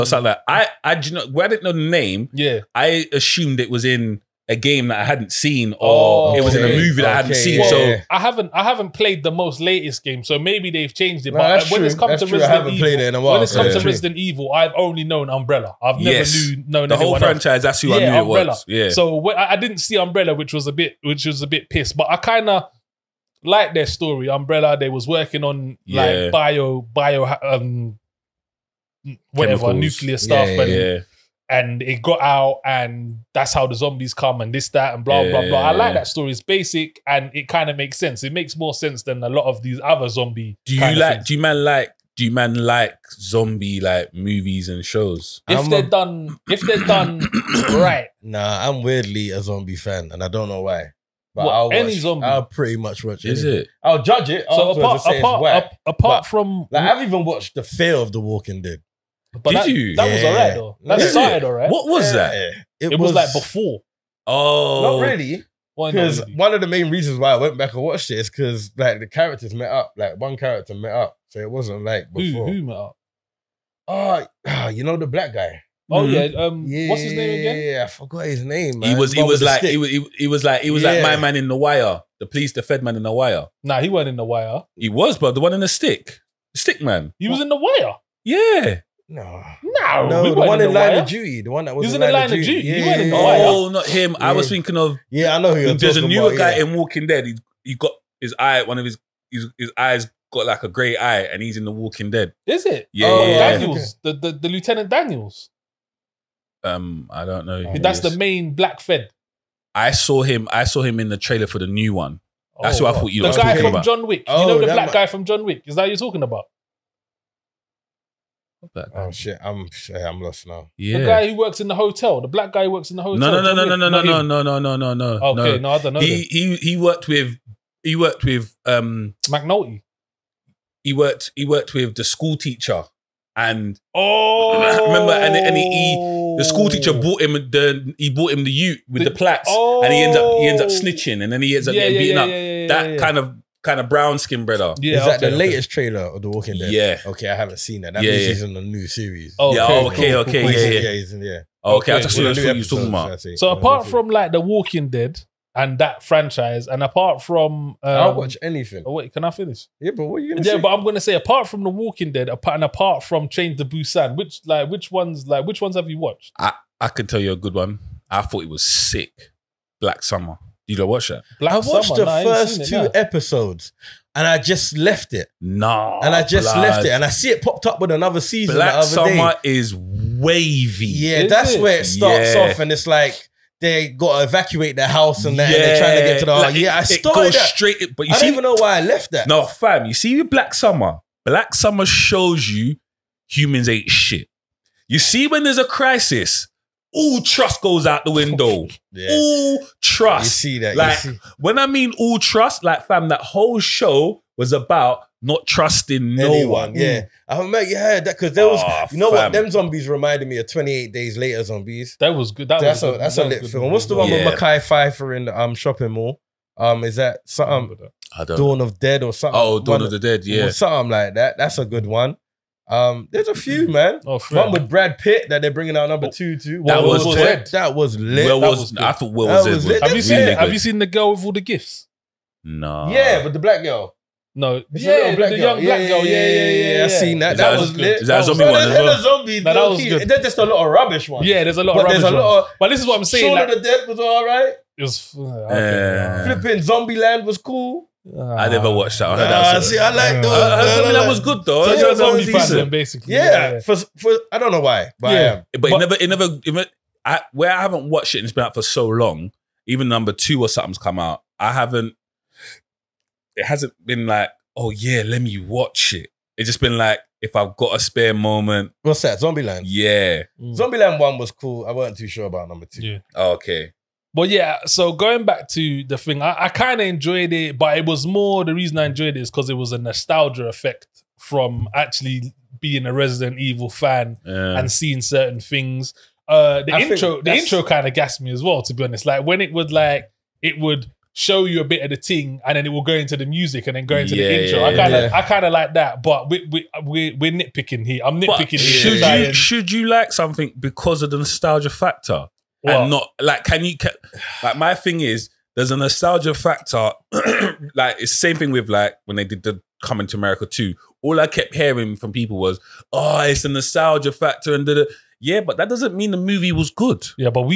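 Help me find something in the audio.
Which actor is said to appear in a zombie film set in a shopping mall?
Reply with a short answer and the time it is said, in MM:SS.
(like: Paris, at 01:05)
Mekhi Phifer, at 03:34.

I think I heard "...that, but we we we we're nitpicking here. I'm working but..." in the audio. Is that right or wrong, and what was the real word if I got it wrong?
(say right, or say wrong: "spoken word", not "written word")
wrong: "nitpicking", not "working".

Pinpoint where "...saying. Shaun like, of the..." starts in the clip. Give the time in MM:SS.
04:03.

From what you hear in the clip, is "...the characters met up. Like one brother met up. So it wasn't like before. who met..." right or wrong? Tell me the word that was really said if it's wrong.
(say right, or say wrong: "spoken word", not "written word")
wrong: "character", not "brother".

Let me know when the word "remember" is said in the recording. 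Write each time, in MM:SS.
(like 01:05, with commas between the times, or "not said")
02:14, 03:27.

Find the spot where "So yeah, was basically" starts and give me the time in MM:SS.
04:11.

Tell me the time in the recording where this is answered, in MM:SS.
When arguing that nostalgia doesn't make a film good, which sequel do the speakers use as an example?
05:09.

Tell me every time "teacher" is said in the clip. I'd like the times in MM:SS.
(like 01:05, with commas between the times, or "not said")
02:12, 02:16.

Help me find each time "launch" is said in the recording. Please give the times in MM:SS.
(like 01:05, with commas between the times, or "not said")
not said.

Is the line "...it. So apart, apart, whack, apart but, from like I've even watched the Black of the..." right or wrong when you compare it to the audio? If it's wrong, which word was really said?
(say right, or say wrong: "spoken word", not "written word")
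wrong: "Fear", not "Black".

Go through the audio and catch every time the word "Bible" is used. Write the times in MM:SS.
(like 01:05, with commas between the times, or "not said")
not said.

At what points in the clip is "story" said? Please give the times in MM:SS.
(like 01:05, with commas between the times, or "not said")
00:23, 00:36.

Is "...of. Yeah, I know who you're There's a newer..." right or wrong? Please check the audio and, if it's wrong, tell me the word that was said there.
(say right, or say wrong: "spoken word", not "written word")
right.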